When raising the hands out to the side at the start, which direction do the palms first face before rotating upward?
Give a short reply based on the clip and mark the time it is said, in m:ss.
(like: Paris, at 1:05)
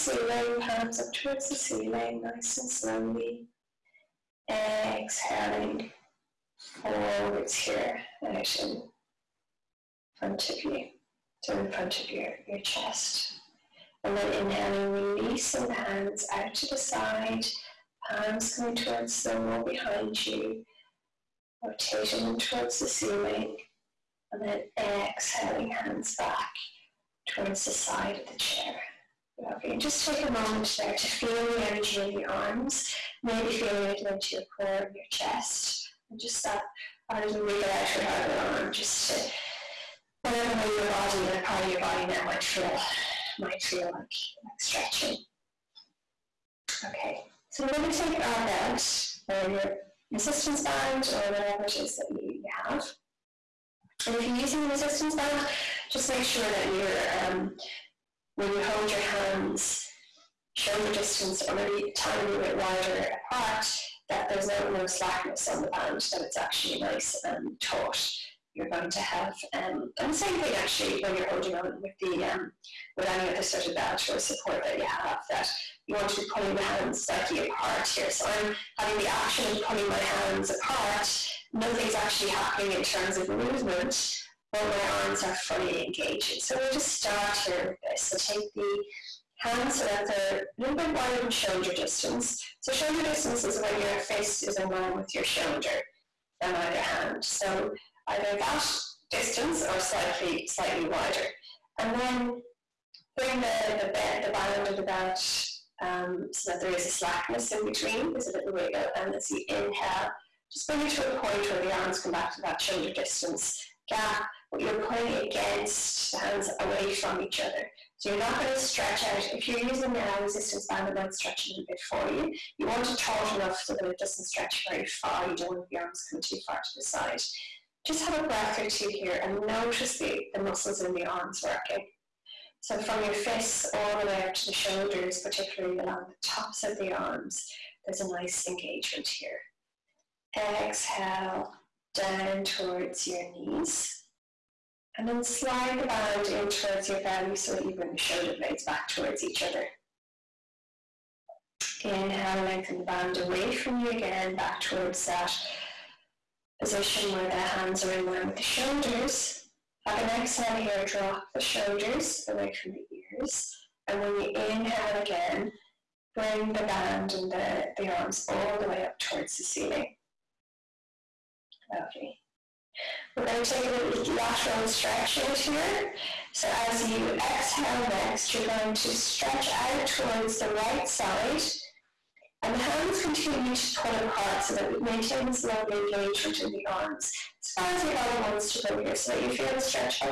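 the wall behind you, at 0:19.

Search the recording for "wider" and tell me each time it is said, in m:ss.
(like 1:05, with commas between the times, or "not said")
1:02, 1:30, 1:40.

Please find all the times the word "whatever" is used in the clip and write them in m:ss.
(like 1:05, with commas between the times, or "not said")
0:40, 0:51.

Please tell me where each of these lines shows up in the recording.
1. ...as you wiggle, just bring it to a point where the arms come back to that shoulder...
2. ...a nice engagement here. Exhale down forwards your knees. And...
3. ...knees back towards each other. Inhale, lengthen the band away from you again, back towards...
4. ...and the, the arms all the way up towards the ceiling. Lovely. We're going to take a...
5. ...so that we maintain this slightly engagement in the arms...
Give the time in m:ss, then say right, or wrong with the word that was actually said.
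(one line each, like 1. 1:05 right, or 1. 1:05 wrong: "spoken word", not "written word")
1. 1:49 wrong: "inhale", not "wiggle"
2. 2:18 wrong: "towards", not "forwards"
3. 2:28 wrong: "blades", not "knees"
4. 2:47 right
5. 3:04 wrong: "lovely", not "slightly".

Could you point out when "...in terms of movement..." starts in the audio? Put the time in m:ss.
1:22.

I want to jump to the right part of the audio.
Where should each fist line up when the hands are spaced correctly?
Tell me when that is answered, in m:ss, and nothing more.
1:34.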